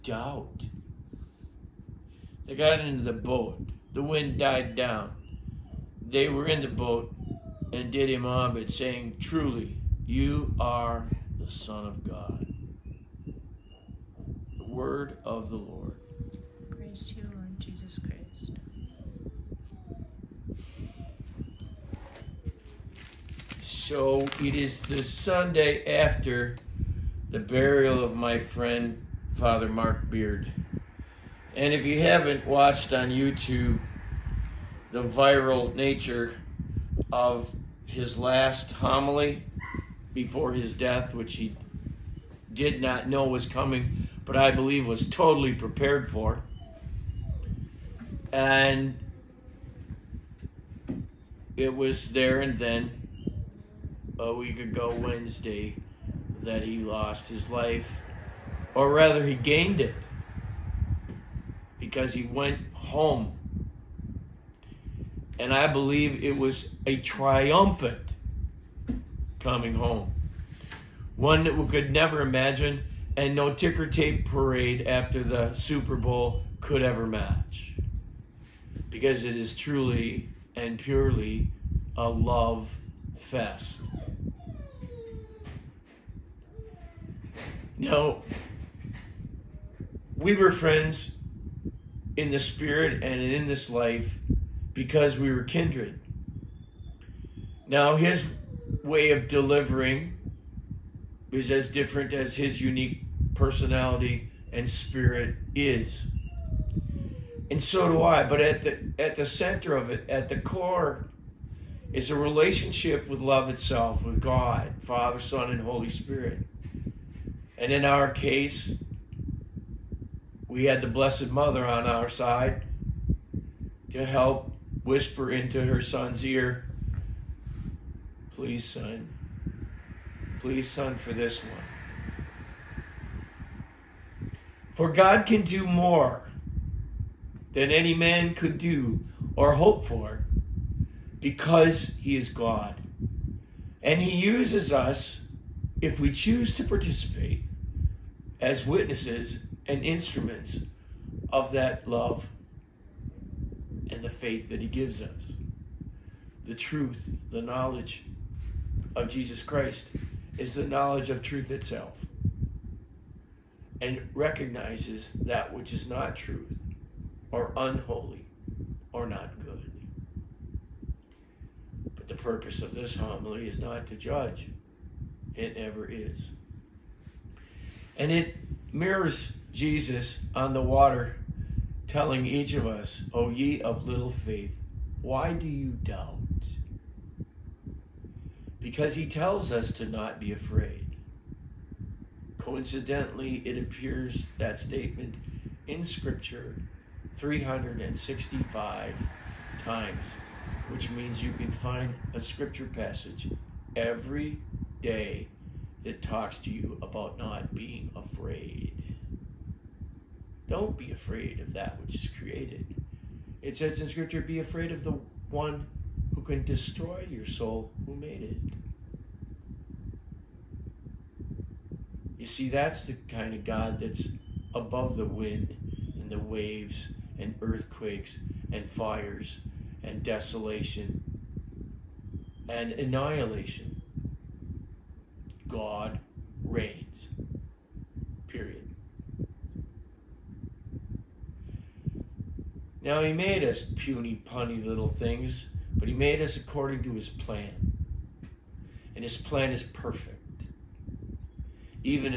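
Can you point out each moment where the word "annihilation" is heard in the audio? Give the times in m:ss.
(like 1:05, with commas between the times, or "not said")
3:52.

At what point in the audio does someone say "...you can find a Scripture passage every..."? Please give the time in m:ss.
3:21.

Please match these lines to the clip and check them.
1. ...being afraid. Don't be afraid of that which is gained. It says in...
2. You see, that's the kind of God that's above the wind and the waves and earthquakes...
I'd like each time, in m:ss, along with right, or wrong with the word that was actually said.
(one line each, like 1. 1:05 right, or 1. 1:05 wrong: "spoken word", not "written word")
1. 3:27 wrong: "created", not "gained"
2. 3:42 right.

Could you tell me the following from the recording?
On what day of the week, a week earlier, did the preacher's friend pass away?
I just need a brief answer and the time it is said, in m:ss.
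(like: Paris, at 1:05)
Wednesday, at 0:54.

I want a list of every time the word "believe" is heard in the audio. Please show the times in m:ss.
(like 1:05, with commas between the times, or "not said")
0:44, 1:05.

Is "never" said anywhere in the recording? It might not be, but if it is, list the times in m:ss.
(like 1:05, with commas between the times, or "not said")
1:11, 2:55.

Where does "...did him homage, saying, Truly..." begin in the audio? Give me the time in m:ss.
0:07.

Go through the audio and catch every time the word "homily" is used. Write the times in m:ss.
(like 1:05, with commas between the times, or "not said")
0:38, 2:52.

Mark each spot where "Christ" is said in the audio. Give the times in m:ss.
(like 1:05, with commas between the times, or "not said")
0:17, 2:39.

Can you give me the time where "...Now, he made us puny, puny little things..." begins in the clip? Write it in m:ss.
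4:02.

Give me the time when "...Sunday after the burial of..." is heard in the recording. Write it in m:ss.
0:25.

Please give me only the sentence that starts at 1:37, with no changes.
Now, his way of delivering is as different as his unique personality and spirit is.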